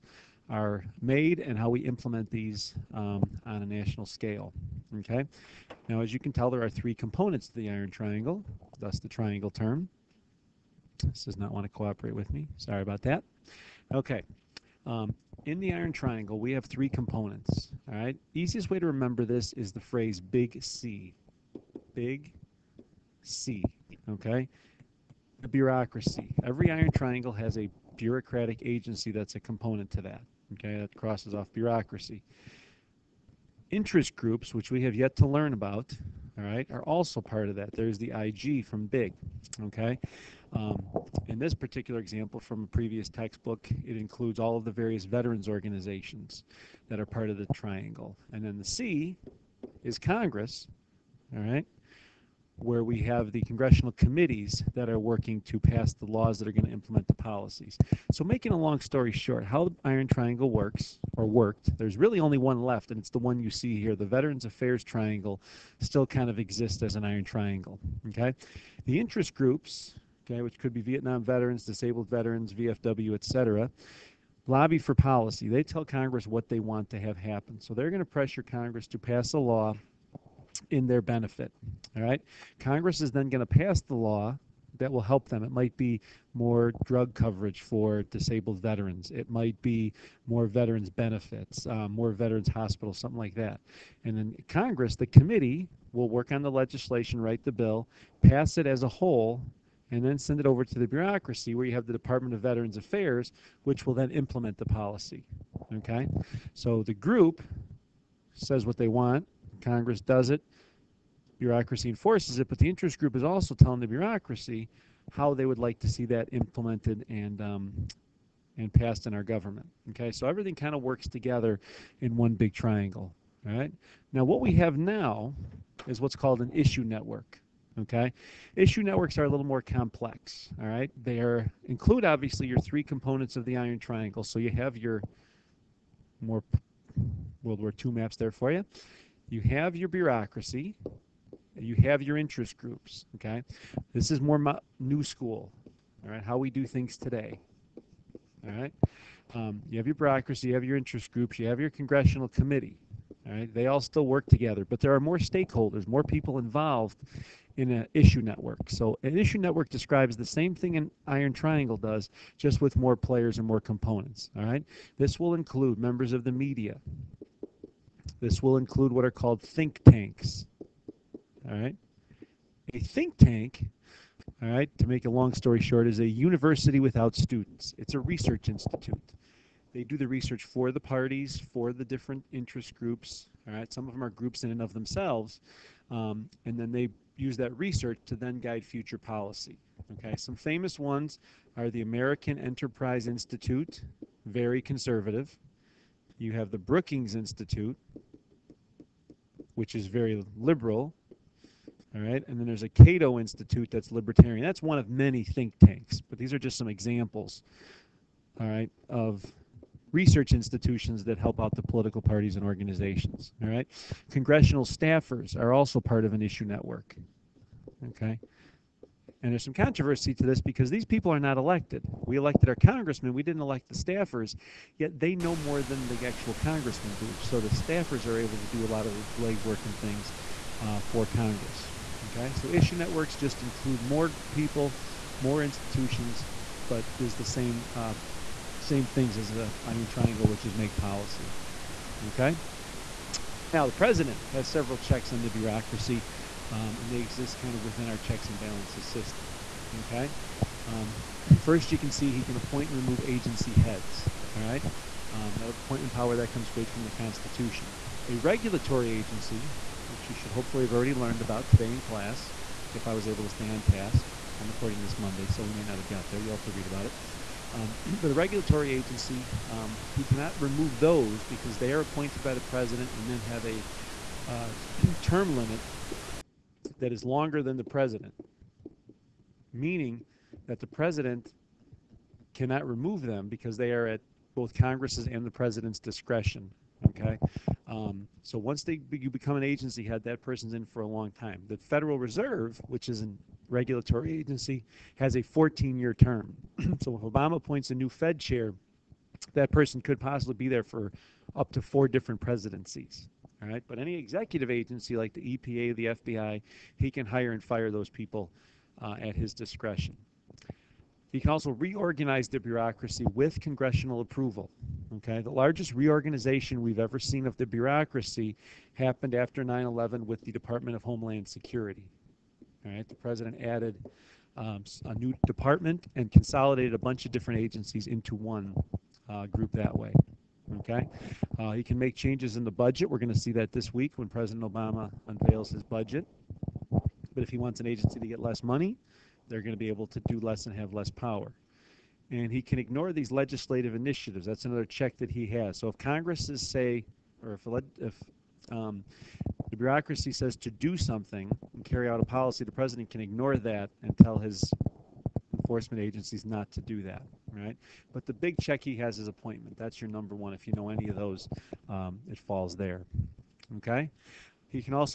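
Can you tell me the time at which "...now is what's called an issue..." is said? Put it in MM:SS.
02:04.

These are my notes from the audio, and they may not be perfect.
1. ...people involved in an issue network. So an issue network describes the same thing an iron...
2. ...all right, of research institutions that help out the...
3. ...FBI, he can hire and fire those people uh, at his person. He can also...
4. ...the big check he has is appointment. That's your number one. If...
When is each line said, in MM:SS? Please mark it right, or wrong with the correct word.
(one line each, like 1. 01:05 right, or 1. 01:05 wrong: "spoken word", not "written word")
1. 02:36 right
2. 03:28 right
3. 05:05 wrong: "discretion", not "person"
4. 05:58 right.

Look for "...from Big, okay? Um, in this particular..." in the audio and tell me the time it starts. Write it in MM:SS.
00:38.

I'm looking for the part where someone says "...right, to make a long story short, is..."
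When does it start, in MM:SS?
02:54.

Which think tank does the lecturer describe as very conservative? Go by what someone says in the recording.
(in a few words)
American Enterprise Institute.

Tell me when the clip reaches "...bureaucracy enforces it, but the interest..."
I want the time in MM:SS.
01:51.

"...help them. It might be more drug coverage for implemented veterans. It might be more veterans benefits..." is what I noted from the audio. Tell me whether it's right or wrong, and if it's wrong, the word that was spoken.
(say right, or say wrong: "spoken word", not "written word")
wrong: "disabled", not "implemented".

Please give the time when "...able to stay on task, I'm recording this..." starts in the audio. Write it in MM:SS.
04:23.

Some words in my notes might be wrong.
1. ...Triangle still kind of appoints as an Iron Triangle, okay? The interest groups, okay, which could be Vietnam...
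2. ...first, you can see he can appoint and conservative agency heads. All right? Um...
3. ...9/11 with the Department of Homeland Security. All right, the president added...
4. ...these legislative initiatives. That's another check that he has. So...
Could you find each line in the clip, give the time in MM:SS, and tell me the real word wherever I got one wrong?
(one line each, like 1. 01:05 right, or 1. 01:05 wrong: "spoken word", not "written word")
1. 01:04 wrong: "exists", not "appoints"
2. 04:11 wrong: "remove", not "conservative"
3. 05:19 right
4. 05:42 right.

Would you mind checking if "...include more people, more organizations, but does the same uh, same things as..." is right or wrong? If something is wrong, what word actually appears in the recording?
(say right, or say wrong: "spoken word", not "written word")
wrong: "institutions", not "organizations".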